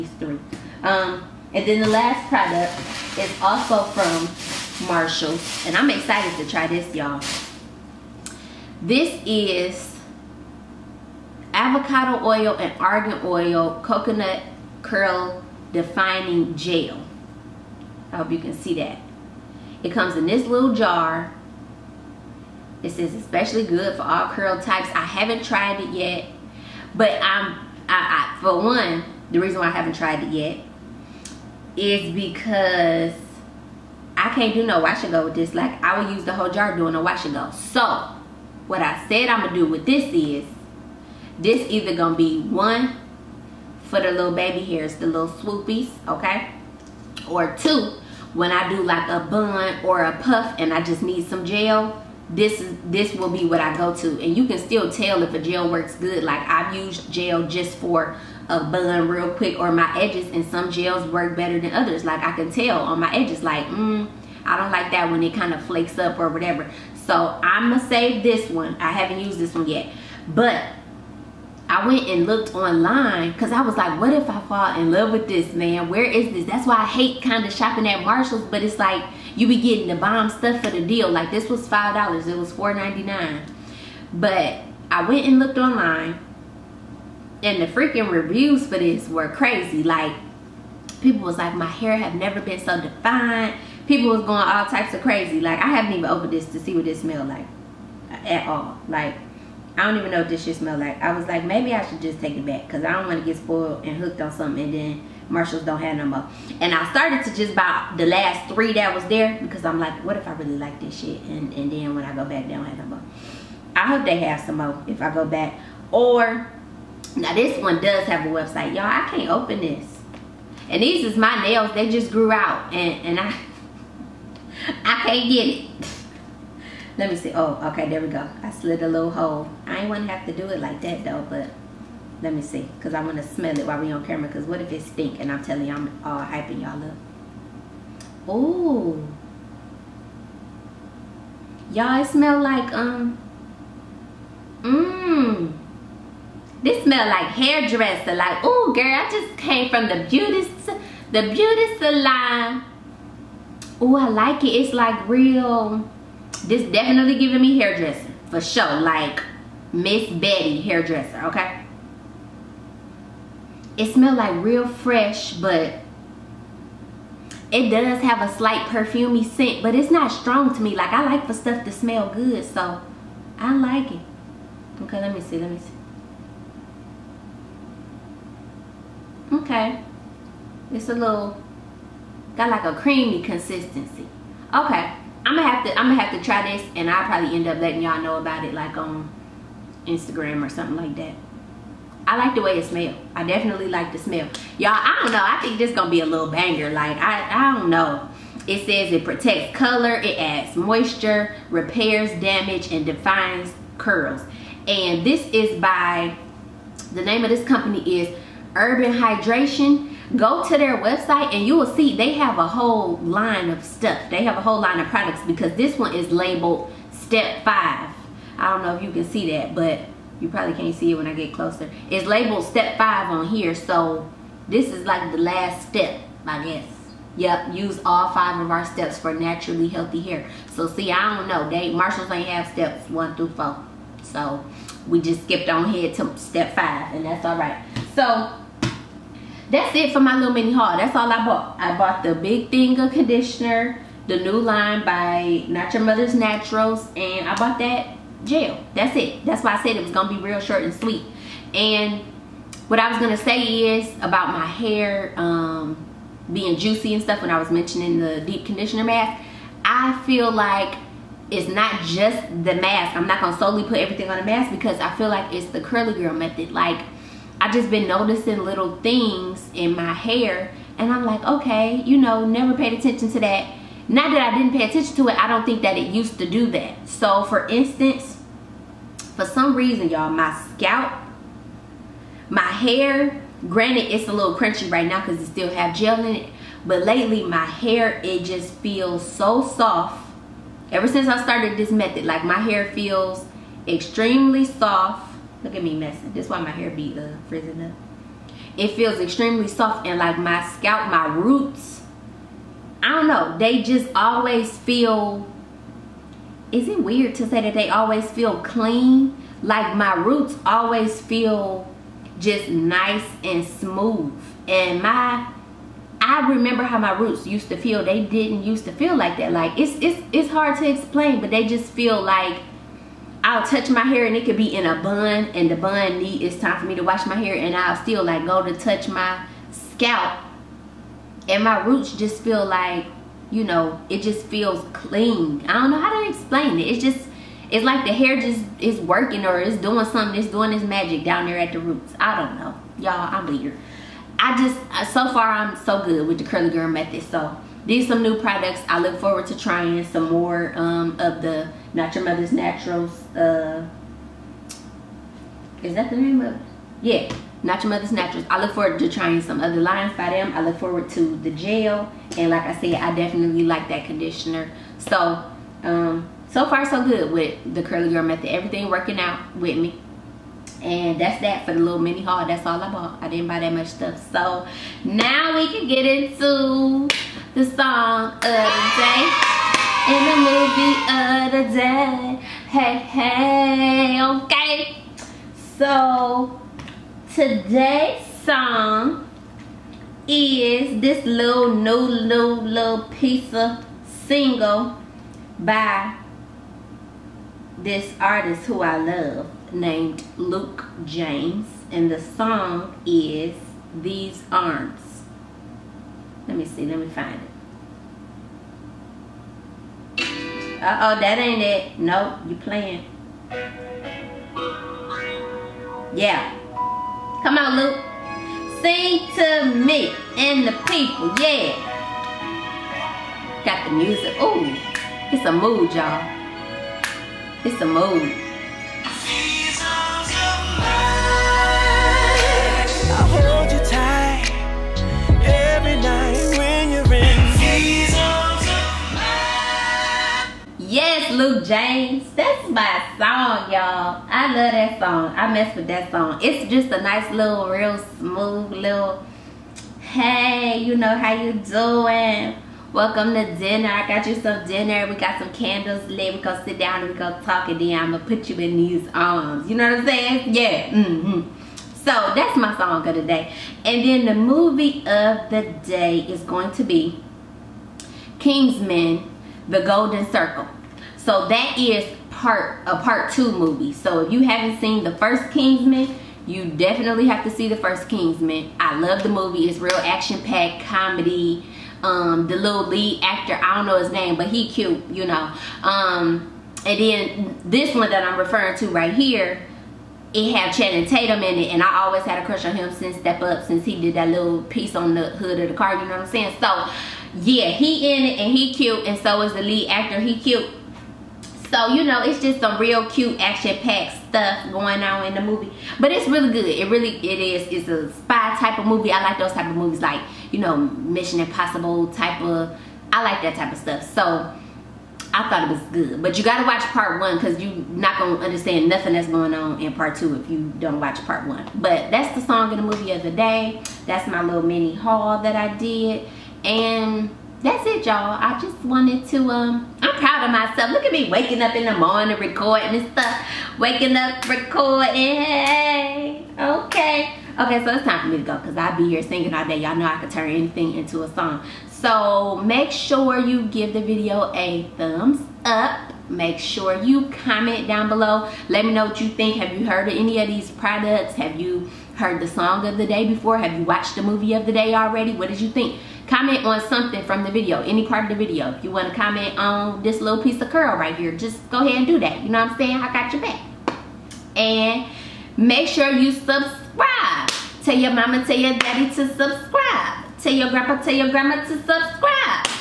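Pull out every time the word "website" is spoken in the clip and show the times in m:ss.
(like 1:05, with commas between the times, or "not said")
1:58, 3:30.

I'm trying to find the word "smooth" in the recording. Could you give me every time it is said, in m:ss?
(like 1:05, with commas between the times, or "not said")
5:13, 7:27.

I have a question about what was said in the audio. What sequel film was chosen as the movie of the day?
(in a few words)
Kingsman: The Golden Circle.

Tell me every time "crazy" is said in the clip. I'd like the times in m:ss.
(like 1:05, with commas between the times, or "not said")
1:29, 1:35.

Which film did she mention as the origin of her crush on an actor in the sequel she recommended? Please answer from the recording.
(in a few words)
Step Up.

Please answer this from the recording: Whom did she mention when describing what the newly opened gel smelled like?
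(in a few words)
Miss Betty hairdresser.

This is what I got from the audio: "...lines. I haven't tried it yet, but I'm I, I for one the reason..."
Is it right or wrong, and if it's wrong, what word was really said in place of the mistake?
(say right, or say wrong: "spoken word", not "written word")
wrong: "types", not "lines".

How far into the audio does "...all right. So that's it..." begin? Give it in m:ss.
3:57.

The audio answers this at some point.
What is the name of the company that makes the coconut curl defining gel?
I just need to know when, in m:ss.
3:28.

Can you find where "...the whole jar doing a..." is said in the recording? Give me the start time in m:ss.
0:36.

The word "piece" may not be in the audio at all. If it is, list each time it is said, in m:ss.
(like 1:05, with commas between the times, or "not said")
6:32, 8:14, 9:20.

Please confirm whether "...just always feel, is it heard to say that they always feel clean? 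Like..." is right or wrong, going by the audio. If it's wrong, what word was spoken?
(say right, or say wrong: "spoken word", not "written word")
wrong: "weird", not "heard".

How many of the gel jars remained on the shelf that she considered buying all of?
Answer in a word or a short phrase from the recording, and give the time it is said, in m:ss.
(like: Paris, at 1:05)
3, at 1:47.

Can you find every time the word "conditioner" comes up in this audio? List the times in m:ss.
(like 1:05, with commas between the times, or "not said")
4:02, 4:18, 6:03.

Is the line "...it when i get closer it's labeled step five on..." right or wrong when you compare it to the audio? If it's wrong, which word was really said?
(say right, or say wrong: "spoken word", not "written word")
right.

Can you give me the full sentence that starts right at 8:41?
But that's the song in the movie of the day.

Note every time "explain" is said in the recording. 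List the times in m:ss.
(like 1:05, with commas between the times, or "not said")
5:20, 5:36.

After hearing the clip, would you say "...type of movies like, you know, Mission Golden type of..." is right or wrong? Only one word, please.
wrong.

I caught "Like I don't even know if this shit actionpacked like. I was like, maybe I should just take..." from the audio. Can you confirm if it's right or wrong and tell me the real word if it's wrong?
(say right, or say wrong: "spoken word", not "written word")
wrong: "smelled", not "actionpacked".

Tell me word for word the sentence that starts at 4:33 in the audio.
Not that I didn't pay attention to it, I don't think that it used to do that.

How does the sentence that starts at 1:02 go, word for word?
Like I can tell on my edges like, mm, I don't like that when it kind of flakes up or whatever.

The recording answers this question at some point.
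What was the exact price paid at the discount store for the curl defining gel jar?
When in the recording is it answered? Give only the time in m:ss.
1:22.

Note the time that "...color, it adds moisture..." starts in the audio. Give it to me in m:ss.
3:19.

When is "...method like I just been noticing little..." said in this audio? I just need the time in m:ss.
4:26.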